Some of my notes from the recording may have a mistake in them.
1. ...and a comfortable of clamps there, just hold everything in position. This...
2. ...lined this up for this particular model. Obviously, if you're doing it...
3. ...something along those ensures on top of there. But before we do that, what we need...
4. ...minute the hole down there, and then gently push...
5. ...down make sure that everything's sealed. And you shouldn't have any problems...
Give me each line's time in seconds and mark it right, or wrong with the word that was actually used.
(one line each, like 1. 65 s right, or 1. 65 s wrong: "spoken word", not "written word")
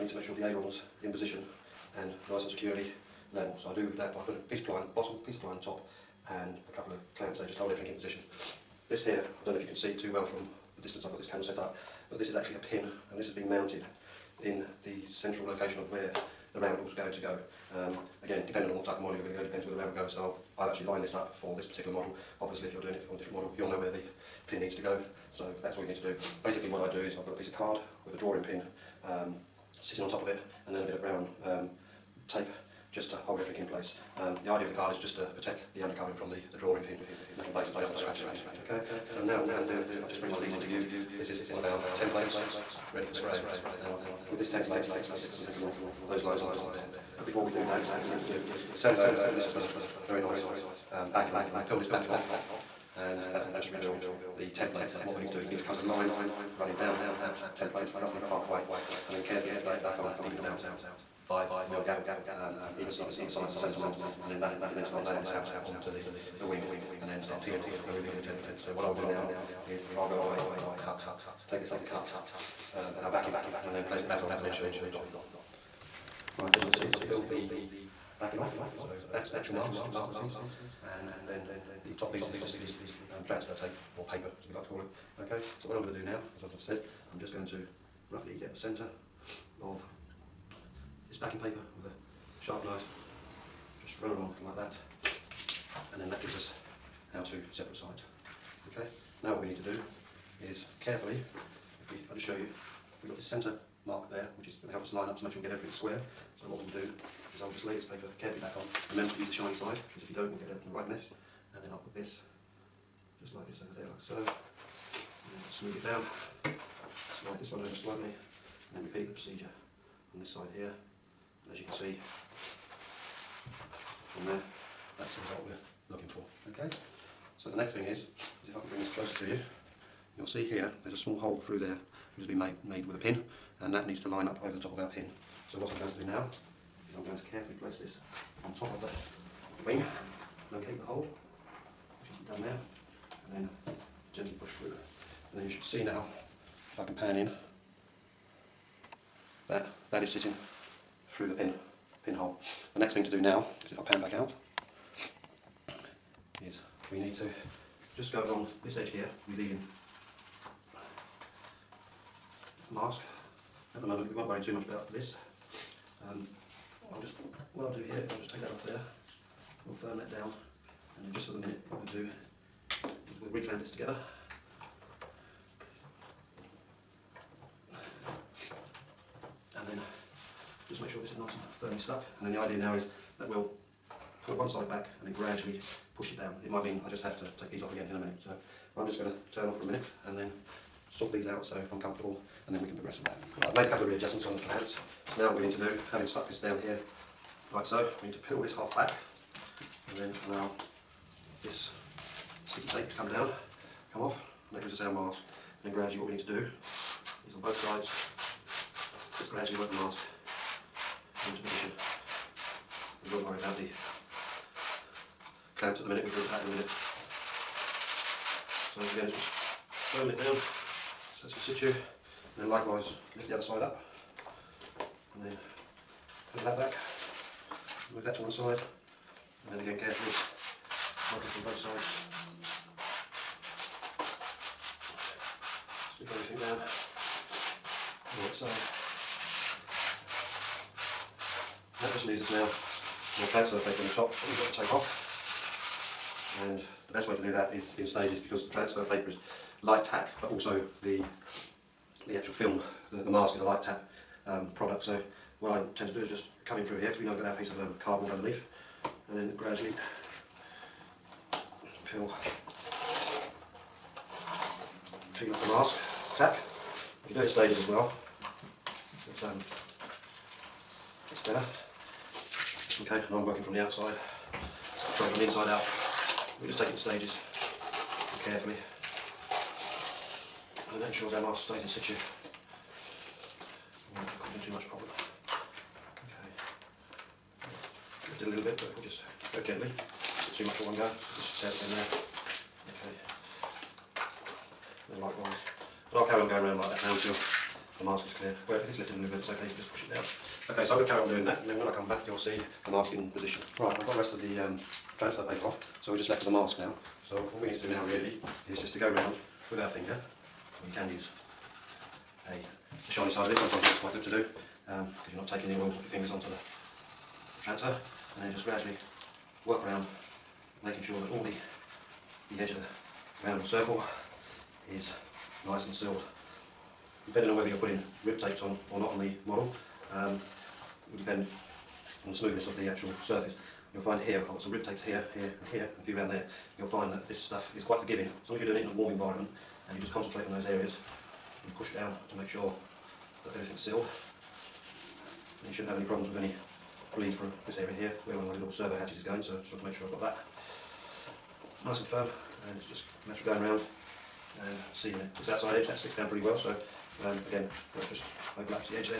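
1. 6 s wrong: "couple", not "comfortable"
2. 20 s right
3. 45 s wrong: "lines", not "ensures"
4. 140 s wrong: "locate", not "minute"
5. 341 s right.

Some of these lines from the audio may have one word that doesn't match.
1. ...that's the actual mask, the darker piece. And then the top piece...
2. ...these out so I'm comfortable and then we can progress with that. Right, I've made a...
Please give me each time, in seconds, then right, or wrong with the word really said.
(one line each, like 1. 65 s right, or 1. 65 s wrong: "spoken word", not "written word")
1. 79 s right
2. 191 s right.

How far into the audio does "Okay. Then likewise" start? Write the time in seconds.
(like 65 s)
292 s.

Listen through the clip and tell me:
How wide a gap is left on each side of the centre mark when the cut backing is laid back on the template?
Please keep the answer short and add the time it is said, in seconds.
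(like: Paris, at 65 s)
5 mil, at 61 s.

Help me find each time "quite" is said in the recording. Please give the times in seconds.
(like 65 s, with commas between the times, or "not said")
313 s, 337 s.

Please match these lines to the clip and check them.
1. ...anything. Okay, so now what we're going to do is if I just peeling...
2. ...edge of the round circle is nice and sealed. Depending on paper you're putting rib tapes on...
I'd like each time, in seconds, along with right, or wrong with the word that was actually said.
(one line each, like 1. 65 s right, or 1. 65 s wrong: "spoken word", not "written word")
1. 38 s wrong: "bring", not "peeling"
2. 322 s wrong: "whether", not "paper".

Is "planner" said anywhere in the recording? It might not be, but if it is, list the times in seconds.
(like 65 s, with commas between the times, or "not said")
not said.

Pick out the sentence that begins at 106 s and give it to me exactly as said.
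So what we'll do so i will just lay this paper carefully back on.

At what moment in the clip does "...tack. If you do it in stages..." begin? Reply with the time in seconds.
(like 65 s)
266 s.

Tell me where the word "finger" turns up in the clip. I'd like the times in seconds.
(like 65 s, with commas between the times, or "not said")
309 s, 315 s.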